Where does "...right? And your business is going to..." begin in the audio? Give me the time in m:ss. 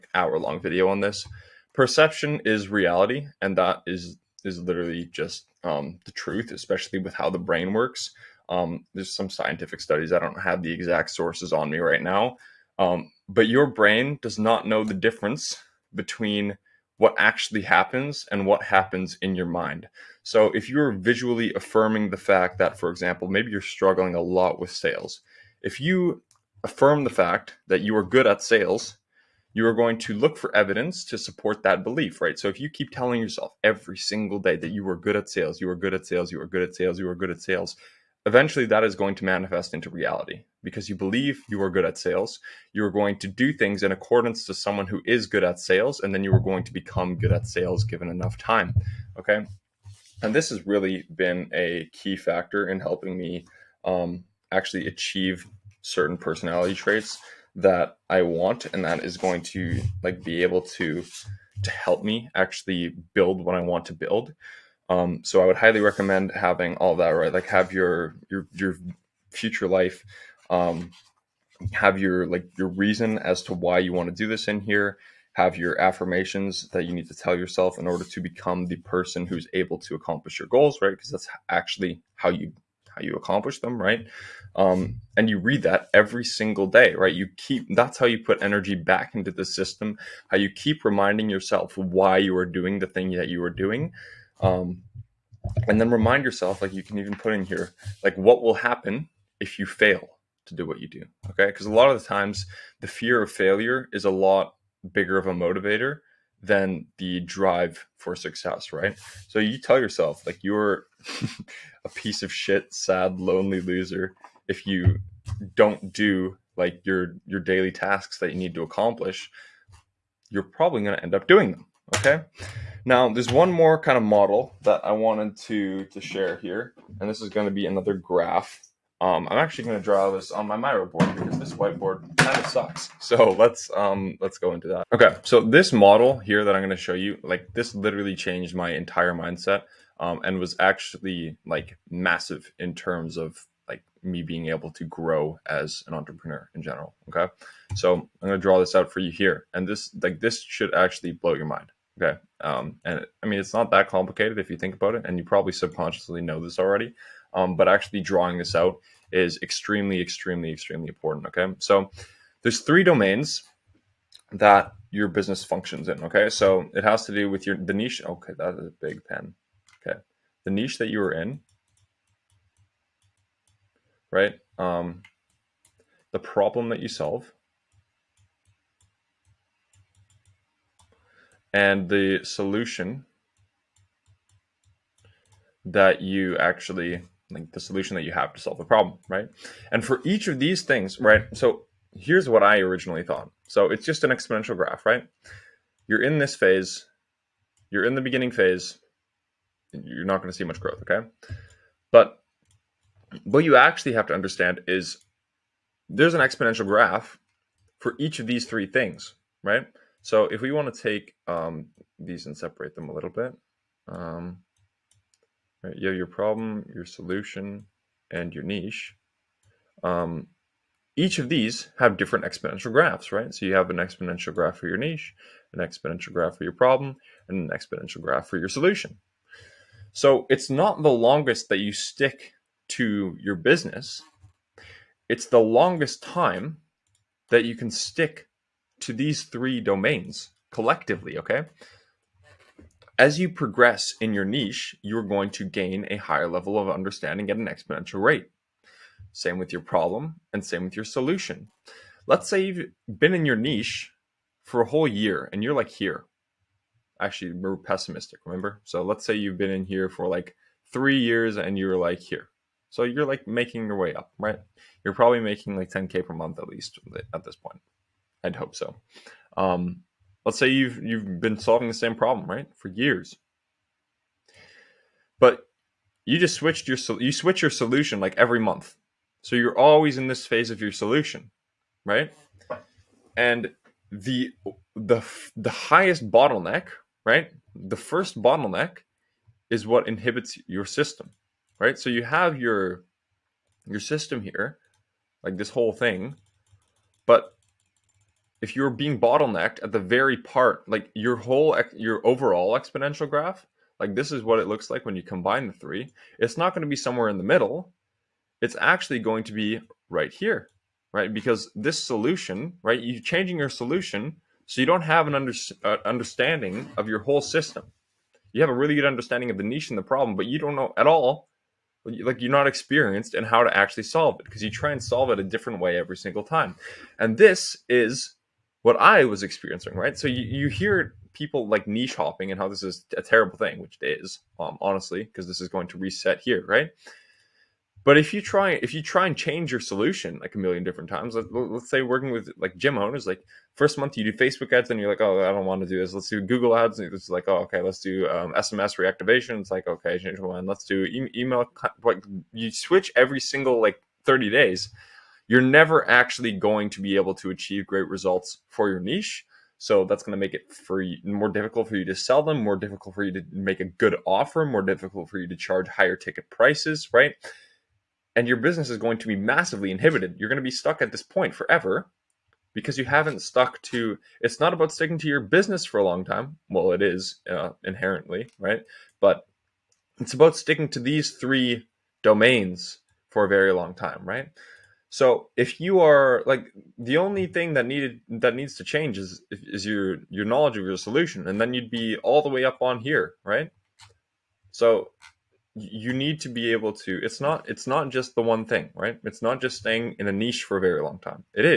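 6:06.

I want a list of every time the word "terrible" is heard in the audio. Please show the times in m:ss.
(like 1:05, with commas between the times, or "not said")
5:33.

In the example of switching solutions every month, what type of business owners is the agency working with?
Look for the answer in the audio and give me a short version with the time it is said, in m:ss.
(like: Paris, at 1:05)
gym owners, at 5:42.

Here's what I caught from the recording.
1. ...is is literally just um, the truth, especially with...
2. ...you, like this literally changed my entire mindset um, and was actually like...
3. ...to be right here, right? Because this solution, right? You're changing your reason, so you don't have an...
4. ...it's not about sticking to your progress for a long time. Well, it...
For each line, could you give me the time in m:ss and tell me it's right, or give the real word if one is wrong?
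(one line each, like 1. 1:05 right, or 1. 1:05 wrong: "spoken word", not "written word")
1. 0:03 right
2. 2:16 right
3. 5:09 wrong: "solution", not "reason"
4. 6:14 wrong: "business", not "progress".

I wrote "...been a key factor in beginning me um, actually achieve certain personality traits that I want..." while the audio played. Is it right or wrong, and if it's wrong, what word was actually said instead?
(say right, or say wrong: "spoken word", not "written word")
wrong: "helping", not "beginning".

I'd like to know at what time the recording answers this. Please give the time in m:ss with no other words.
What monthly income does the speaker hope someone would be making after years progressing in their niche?
4:25.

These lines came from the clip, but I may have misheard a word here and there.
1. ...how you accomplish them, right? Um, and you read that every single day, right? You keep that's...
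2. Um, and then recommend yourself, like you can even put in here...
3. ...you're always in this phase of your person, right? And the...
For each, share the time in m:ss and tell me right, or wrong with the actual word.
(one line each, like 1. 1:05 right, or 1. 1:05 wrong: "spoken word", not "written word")
1. 1:22 right
2. 1:34 wrong: "remind", not "recommend"
3. 4:39 wrong: "solution", not "person".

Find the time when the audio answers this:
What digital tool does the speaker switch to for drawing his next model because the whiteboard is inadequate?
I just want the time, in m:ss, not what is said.
2:10.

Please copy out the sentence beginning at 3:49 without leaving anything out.
So it's not the longest that you stick to your business.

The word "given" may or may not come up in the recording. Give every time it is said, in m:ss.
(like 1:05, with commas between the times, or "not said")
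0:47.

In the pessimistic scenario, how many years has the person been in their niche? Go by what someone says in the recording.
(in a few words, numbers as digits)
3 years.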